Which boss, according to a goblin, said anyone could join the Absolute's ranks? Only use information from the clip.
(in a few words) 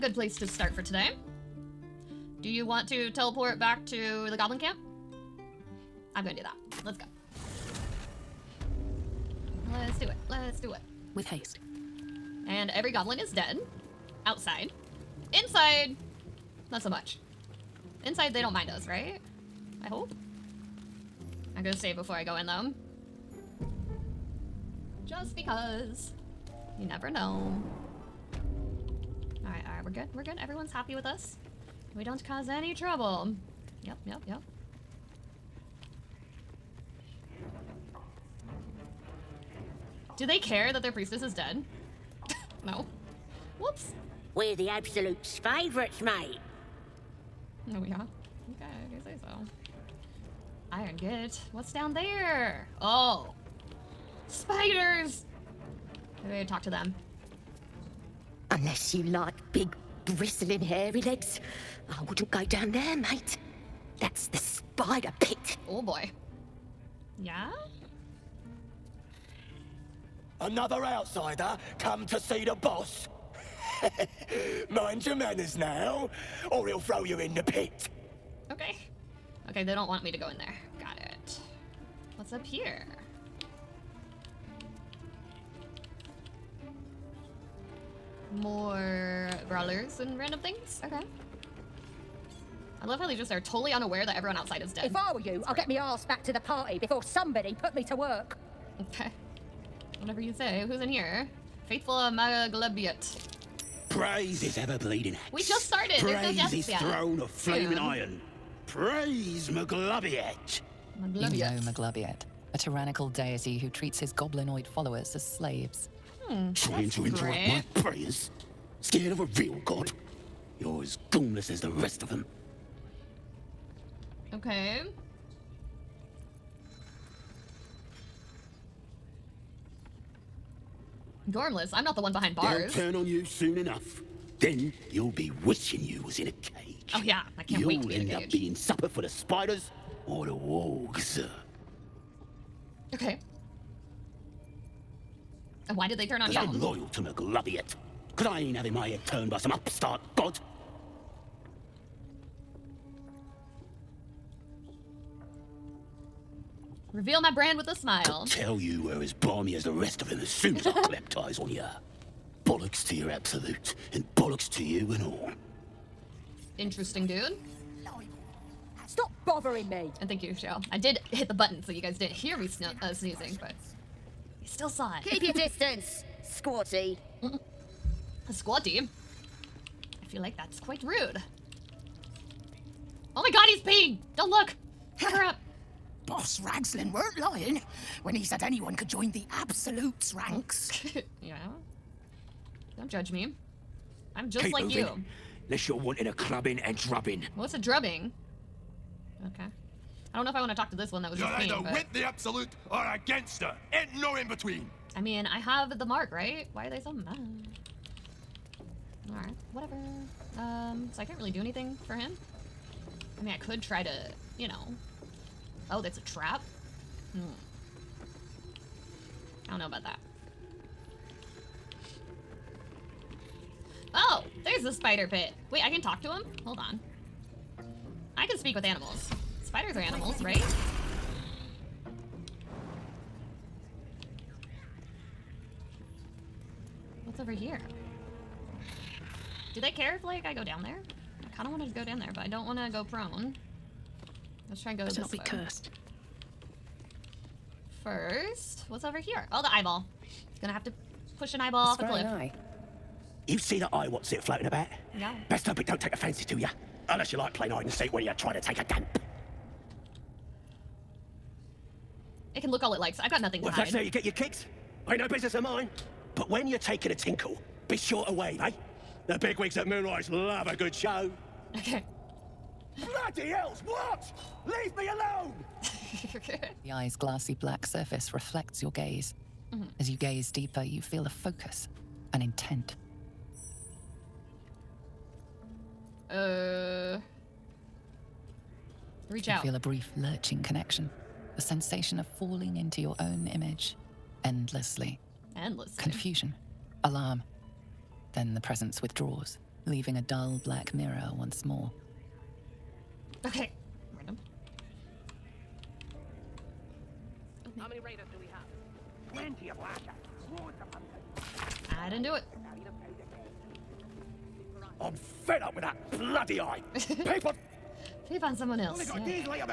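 Boss Razglin.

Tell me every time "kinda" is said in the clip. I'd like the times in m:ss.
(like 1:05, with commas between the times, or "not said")
4:01.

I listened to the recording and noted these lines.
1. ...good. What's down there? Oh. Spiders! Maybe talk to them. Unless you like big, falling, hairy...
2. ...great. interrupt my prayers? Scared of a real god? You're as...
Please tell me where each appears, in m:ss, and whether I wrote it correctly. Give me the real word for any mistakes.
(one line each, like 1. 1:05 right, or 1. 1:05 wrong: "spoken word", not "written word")
1. 0:50 wrong: "bristling", not "falling"
2. 1:57 right.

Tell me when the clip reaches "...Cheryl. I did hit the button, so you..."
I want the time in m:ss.
2:50.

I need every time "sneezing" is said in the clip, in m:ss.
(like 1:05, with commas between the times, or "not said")
2:52.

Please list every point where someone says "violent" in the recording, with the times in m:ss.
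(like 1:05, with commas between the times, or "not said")
not said.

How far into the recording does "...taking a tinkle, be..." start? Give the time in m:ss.
4:26.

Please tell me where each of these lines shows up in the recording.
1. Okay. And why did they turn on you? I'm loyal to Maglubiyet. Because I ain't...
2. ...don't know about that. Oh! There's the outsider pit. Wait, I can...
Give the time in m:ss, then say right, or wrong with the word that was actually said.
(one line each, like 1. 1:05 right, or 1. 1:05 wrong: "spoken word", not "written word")
1. 2:22 right
2. 3:39 wrong: "spider", not "outsider".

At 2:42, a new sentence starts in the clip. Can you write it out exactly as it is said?
Bollocks to your absolute, and bollocks to you and all.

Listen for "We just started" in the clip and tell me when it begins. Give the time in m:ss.
1:45.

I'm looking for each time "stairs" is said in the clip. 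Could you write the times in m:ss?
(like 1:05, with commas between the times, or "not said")
not said.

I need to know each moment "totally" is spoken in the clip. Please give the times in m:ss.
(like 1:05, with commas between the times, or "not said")
1:33.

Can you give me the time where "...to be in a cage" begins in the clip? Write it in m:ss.
2:17.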